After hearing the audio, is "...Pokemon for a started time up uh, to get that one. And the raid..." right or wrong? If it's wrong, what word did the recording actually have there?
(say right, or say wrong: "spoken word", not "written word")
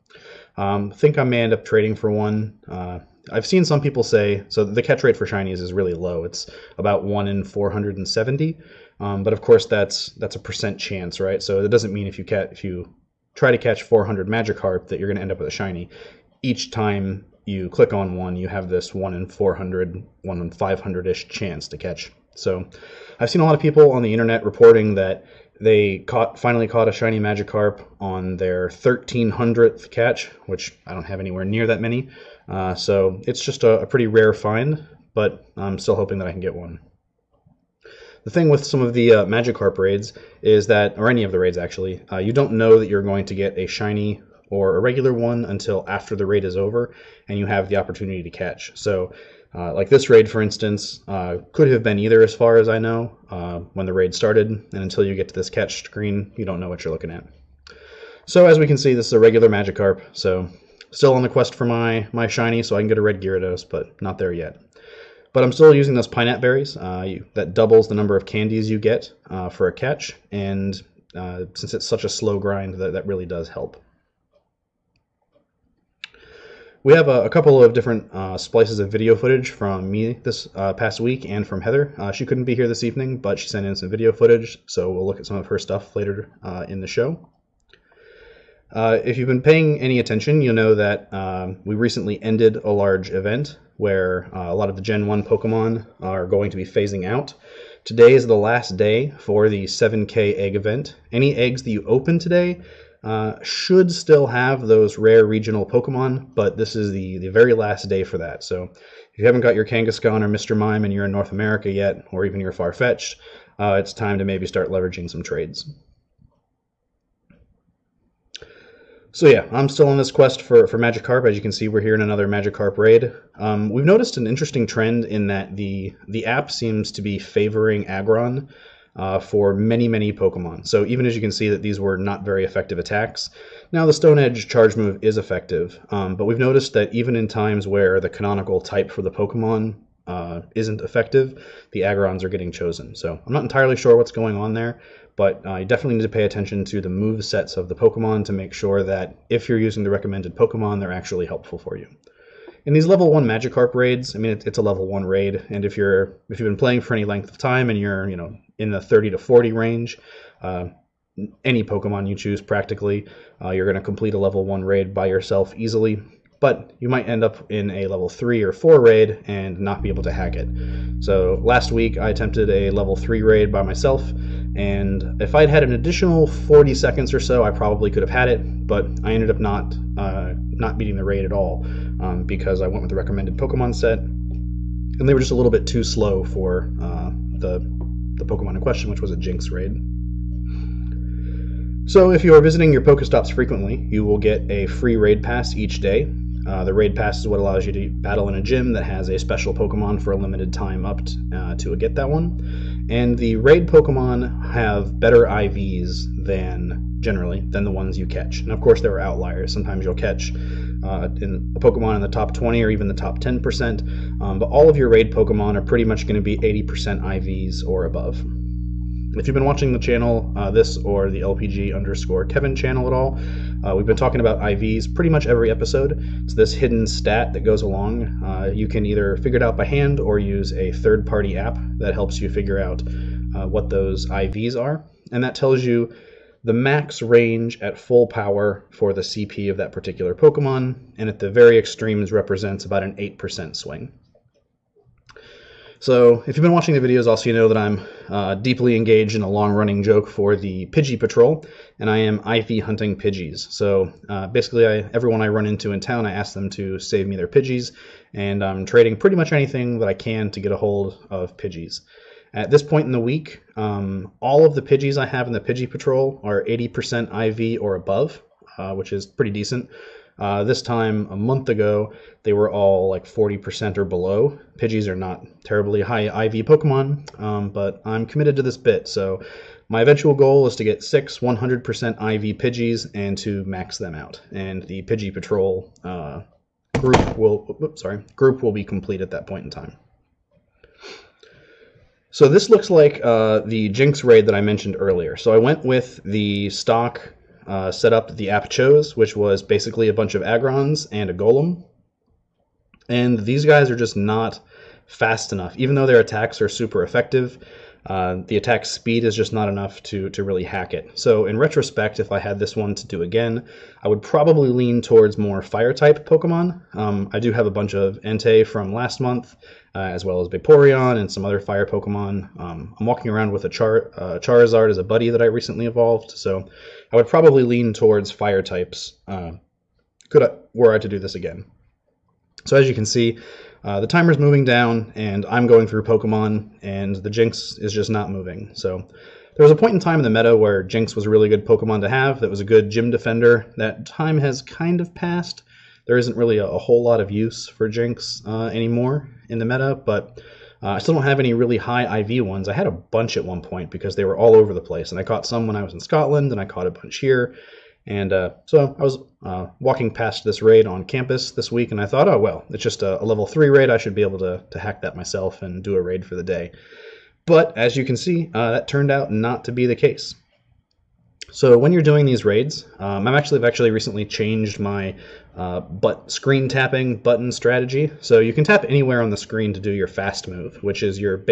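wrong: "limited", not "started".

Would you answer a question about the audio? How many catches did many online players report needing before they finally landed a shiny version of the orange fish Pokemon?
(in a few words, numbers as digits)
1300.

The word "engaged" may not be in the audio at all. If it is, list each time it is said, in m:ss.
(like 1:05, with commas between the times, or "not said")
4:08.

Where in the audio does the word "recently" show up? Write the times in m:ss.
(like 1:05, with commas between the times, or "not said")
1:31, 5:25, 6:13.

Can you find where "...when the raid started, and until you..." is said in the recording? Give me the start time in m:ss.
0:53.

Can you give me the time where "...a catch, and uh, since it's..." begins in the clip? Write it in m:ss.
1:09.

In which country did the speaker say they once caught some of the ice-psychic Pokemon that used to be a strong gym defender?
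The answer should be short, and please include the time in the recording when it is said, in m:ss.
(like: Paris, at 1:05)
Scotland, at 5:55.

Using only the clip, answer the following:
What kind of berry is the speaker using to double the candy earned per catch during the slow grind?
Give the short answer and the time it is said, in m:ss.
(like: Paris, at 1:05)
Pineapple Berries, at 1:06.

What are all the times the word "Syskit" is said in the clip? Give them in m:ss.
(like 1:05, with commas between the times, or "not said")
not said.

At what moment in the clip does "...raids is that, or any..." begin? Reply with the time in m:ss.
0:39.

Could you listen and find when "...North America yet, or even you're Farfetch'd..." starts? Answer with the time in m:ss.
1:51.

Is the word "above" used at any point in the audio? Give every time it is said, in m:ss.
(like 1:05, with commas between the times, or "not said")
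3:37, 4:27.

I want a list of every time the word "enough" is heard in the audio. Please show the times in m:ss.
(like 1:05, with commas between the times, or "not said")
5:05, 5:09.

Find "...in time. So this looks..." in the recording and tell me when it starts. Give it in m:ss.
4:49.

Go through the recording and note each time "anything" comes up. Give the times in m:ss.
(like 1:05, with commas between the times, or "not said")
4:19.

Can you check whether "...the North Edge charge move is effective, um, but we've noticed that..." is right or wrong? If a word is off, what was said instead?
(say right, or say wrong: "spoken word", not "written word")
wrong: "Stone", not "North".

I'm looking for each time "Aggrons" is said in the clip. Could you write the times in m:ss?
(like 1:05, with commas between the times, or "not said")
2:07, 2:21, 5:00.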